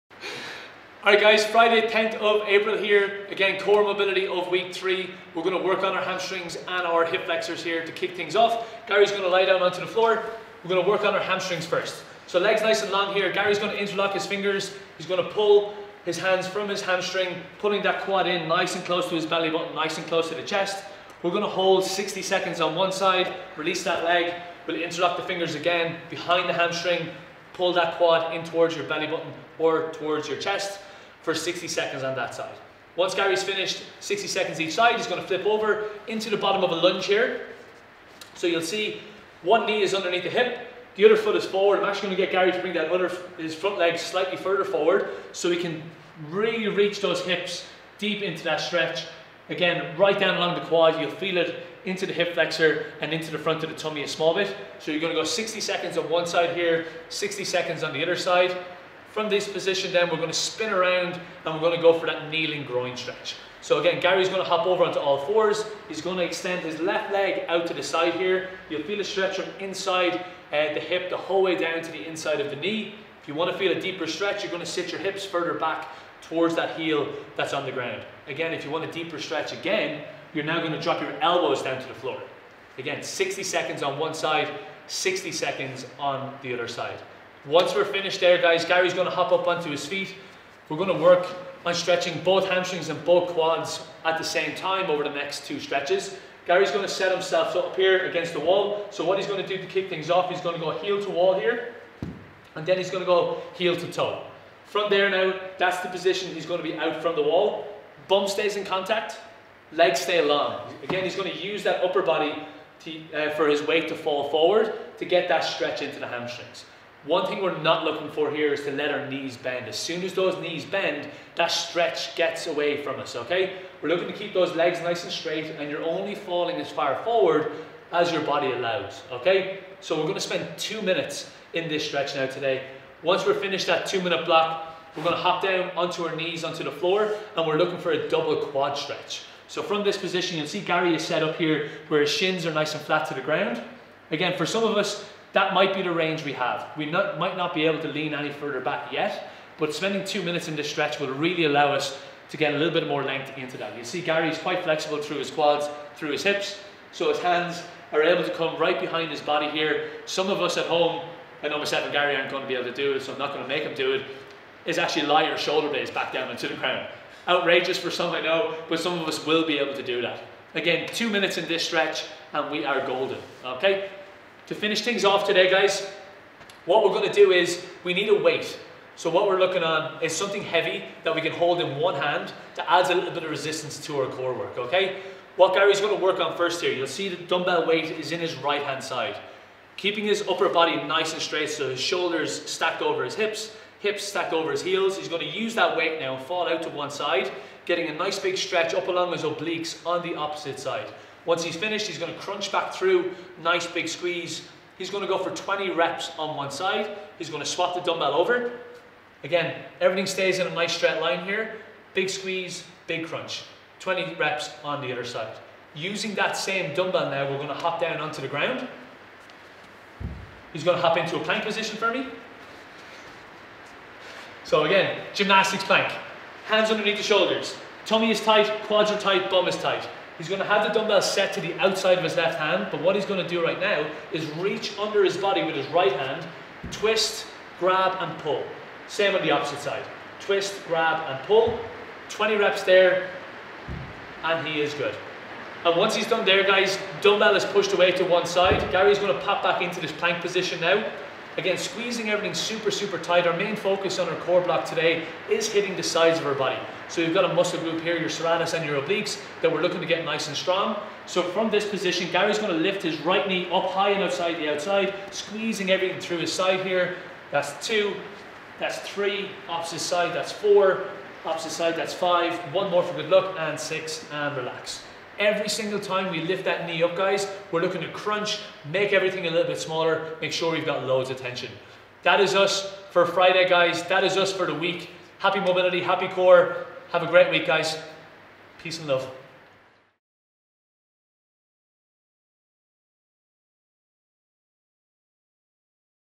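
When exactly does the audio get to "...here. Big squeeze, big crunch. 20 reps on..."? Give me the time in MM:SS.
03:31.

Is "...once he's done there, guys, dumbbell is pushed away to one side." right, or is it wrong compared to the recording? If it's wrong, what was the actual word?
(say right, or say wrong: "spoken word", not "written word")
right.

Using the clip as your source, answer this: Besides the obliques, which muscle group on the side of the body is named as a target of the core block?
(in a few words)
serratus.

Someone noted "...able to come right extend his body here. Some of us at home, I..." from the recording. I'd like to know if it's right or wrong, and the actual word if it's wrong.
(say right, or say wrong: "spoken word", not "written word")
wrong: "behind", not "extend".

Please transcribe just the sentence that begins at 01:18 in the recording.
Again, if you want a deeper stretch again, you're now gonna drop your elbows down to the floor.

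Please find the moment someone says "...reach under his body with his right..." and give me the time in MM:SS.
03:54.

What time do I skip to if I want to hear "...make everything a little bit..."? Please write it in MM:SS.
04:38.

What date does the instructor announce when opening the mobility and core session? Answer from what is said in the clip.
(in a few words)
Friday 10th of April.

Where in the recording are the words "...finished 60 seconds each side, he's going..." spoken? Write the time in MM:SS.
00:33.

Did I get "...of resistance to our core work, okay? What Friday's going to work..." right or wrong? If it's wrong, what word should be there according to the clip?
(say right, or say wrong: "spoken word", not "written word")
wrong: "Gary", not "Friday".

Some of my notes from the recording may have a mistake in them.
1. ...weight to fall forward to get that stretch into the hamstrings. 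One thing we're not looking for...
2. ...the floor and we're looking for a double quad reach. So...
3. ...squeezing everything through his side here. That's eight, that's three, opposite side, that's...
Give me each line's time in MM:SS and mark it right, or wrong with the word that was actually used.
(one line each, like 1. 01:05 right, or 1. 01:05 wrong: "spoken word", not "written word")
1. 01:53 right
2. 02:16 wrong: "stretch", not "reach"
3. 04:25 wrong: "two", not "eight".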